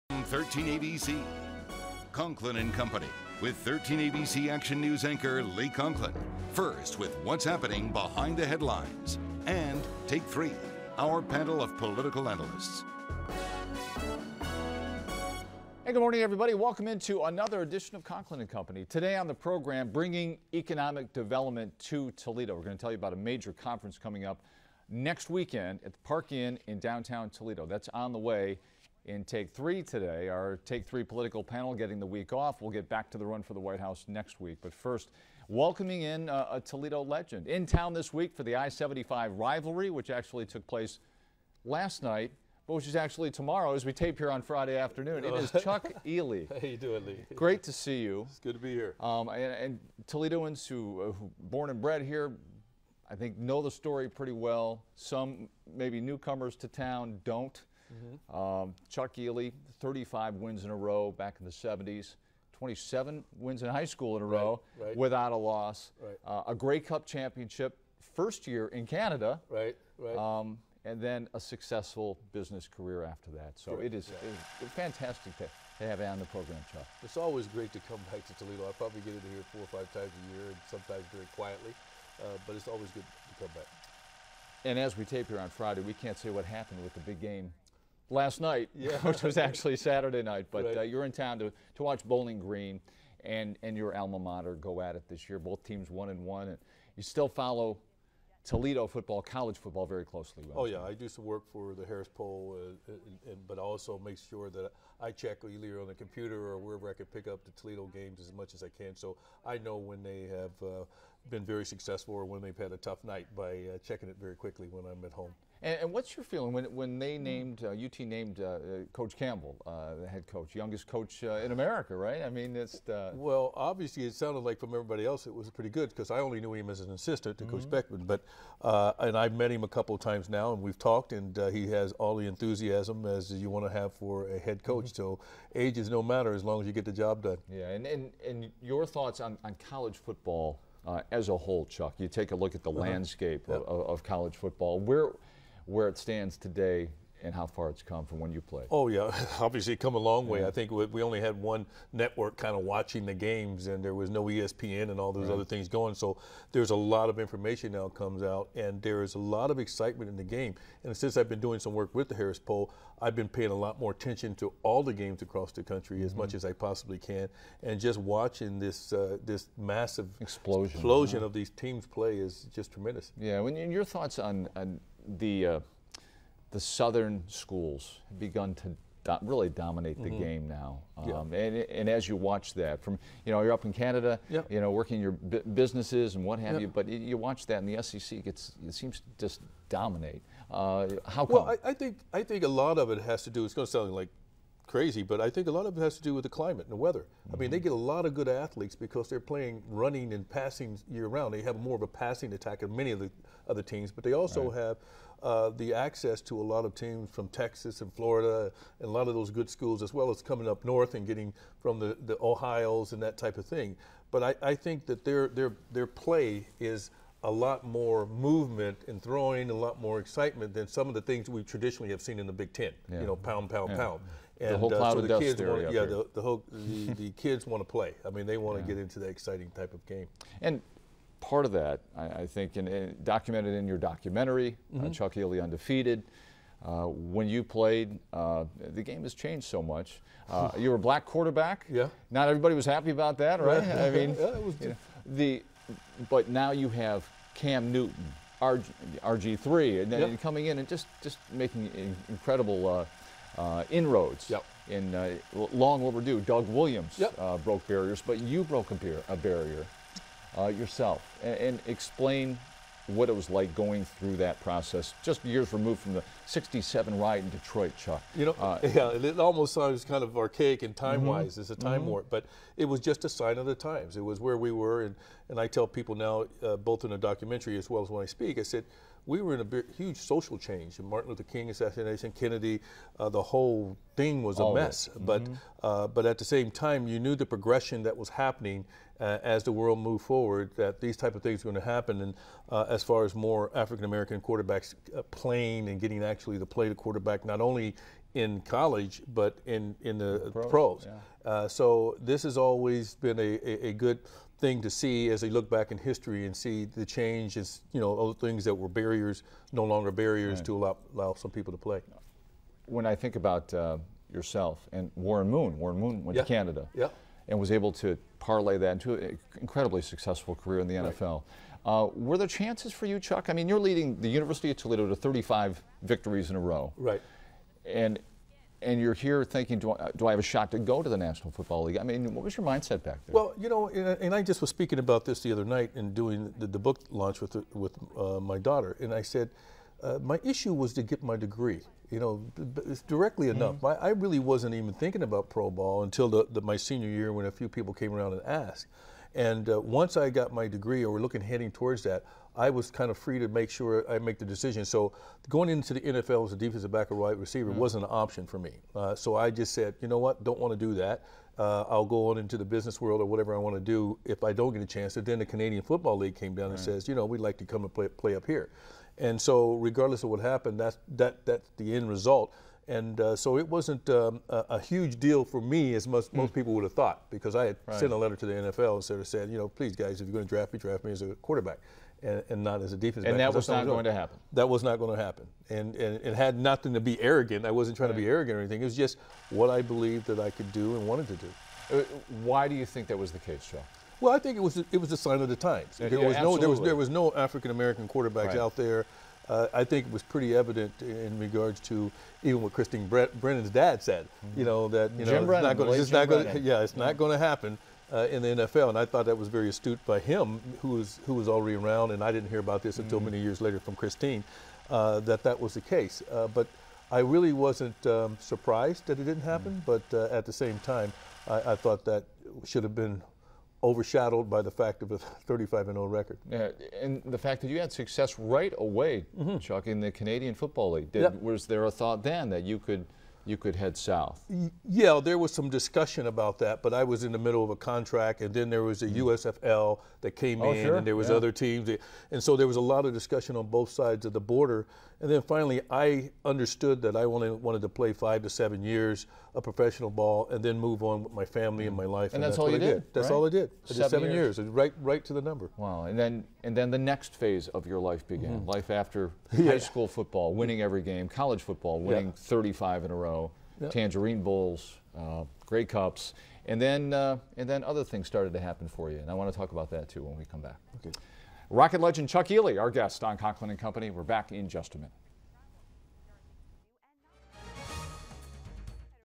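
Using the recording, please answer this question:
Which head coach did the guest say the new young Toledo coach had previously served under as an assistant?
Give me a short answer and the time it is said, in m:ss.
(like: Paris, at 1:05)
Coach Beckman, at 2:07.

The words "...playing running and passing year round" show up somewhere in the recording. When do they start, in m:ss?
3:19.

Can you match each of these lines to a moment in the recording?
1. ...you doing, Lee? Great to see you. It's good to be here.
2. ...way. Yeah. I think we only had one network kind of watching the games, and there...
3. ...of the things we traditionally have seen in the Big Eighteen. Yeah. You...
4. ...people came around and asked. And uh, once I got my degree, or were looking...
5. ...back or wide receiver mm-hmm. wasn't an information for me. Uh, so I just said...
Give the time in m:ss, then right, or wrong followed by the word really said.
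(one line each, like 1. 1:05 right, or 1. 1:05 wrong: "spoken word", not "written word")
1. 0:46 right
2. 2:30 right
3. 3:40 wrong: "Ten", not "Eighteen"
4. 5:47 right
5. 5:56 wrong: "option", not "information".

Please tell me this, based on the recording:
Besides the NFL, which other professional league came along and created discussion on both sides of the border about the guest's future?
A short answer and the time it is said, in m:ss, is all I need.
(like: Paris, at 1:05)
USFL, at 7:19.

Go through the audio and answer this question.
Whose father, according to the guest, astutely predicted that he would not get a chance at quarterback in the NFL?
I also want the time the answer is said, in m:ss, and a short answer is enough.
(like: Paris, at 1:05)
Christine Brennan's, at 6:42.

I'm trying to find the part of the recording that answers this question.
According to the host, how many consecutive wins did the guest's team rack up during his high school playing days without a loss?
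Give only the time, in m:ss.
1:02.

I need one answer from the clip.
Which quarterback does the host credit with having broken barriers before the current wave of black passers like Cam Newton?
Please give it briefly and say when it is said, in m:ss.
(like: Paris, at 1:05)
Doug Williams, at 4:16.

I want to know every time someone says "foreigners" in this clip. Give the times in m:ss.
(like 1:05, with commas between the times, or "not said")
not said.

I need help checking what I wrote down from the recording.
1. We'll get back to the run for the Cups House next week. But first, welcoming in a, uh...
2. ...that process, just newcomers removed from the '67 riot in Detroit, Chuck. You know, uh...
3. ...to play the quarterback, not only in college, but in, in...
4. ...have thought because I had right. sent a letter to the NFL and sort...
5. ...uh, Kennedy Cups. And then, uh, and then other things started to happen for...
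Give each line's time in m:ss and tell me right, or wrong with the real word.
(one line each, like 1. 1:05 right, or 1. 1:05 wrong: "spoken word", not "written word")
1. 0:32 wrong: "White", not "Cups"
2. 4:24 wrong: "years", not "newcomers"
3. 4:56 right
4. 6:16 right
5. 7:44 wrong: "Grey", not "Kennedy".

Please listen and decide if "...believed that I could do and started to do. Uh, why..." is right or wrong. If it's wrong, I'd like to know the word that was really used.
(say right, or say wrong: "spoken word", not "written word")
wrong: "wanted", not "started".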